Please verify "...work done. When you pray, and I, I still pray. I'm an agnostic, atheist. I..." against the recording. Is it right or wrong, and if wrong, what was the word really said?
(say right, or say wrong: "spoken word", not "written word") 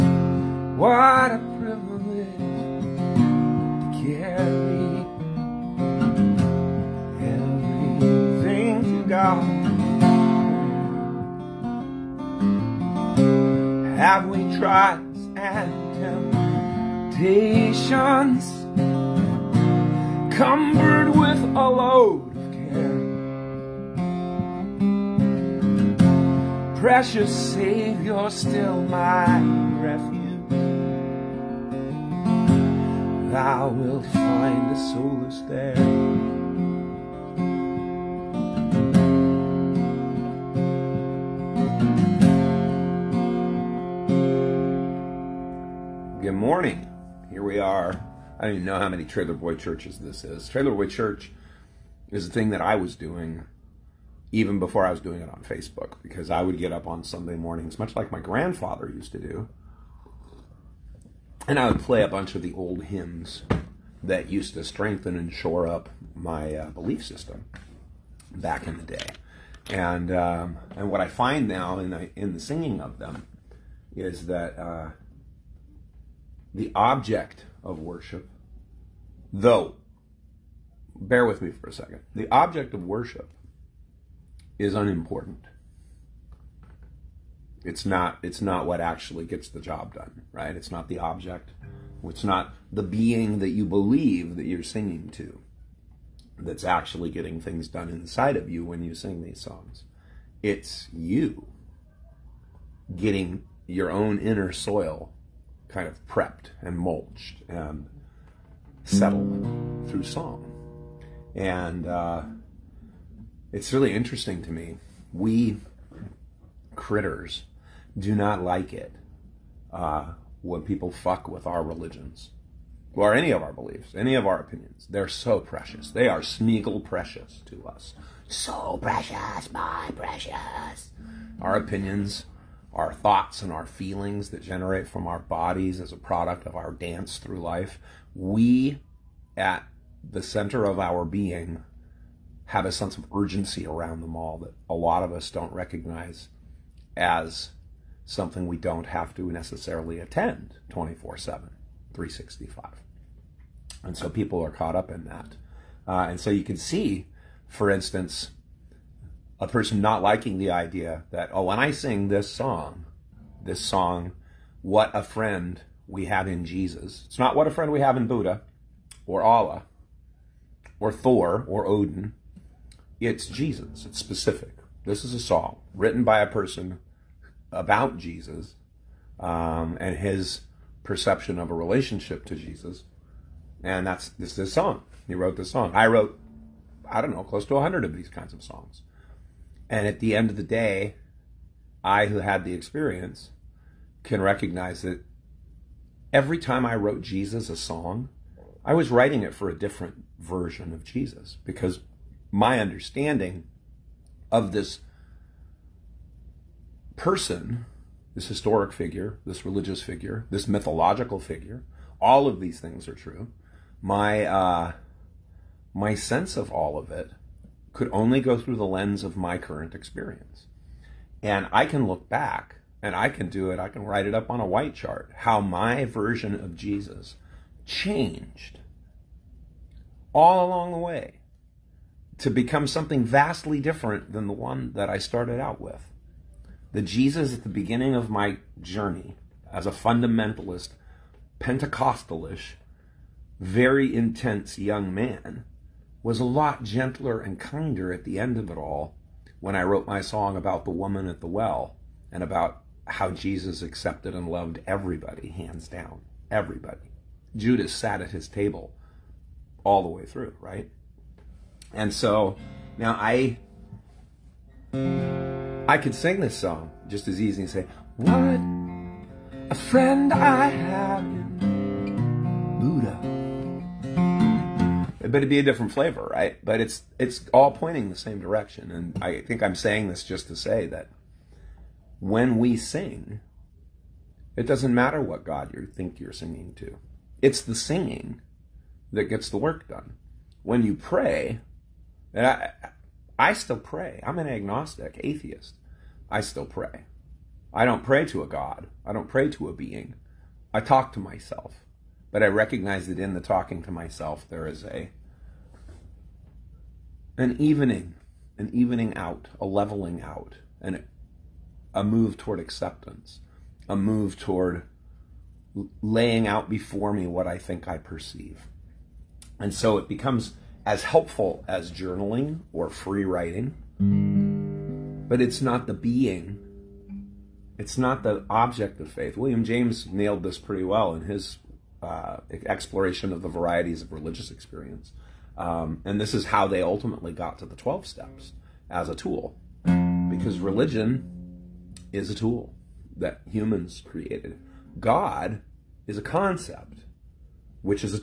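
right.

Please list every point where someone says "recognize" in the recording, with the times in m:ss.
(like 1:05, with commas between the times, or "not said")
2:25, 3:14, 5:02.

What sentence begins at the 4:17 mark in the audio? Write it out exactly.
Judas sat at his table all the way through, right?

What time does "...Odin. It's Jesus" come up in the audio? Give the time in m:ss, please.
2:51.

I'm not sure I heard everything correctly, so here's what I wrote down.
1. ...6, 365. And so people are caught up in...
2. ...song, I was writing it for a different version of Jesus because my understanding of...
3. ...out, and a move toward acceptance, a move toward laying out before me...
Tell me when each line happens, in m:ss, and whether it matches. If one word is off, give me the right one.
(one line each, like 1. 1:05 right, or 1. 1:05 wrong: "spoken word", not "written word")
1. 2:31 wrong: "7", not "6"
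2. 3:17 right
3. 5:10 right.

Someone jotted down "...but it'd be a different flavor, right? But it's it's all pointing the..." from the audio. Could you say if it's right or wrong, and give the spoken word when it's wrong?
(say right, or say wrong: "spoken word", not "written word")
right.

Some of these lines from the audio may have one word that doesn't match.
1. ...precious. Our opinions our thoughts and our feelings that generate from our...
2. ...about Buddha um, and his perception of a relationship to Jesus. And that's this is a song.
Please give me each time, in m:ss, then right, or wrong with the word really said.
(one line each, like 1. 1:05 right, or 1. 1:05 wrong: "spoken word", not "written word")
1. 2:09 right
2. 2:57 wrong: "Jesus", not "Buddha".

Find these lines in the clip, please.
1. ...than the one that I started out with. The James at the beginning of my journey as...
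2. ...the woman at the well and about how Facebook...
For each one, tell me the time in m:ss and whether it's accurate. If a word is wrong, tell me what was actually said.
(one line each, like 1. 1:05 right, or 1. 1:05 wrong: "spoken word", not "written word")
1. 3:54 wrong: "Jesus", not "James"
2. 4:10 wrong: "Jesus", not "Facebook".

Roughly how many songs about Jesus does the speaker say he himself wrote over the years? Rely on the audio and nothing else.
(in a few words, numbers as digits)
100.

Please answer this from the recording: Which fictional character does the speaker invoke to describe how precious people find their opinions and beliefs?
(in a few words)
Smeagol.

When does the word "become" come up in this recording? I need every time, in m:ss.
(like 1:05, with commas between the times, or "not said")
3:52, 5:19.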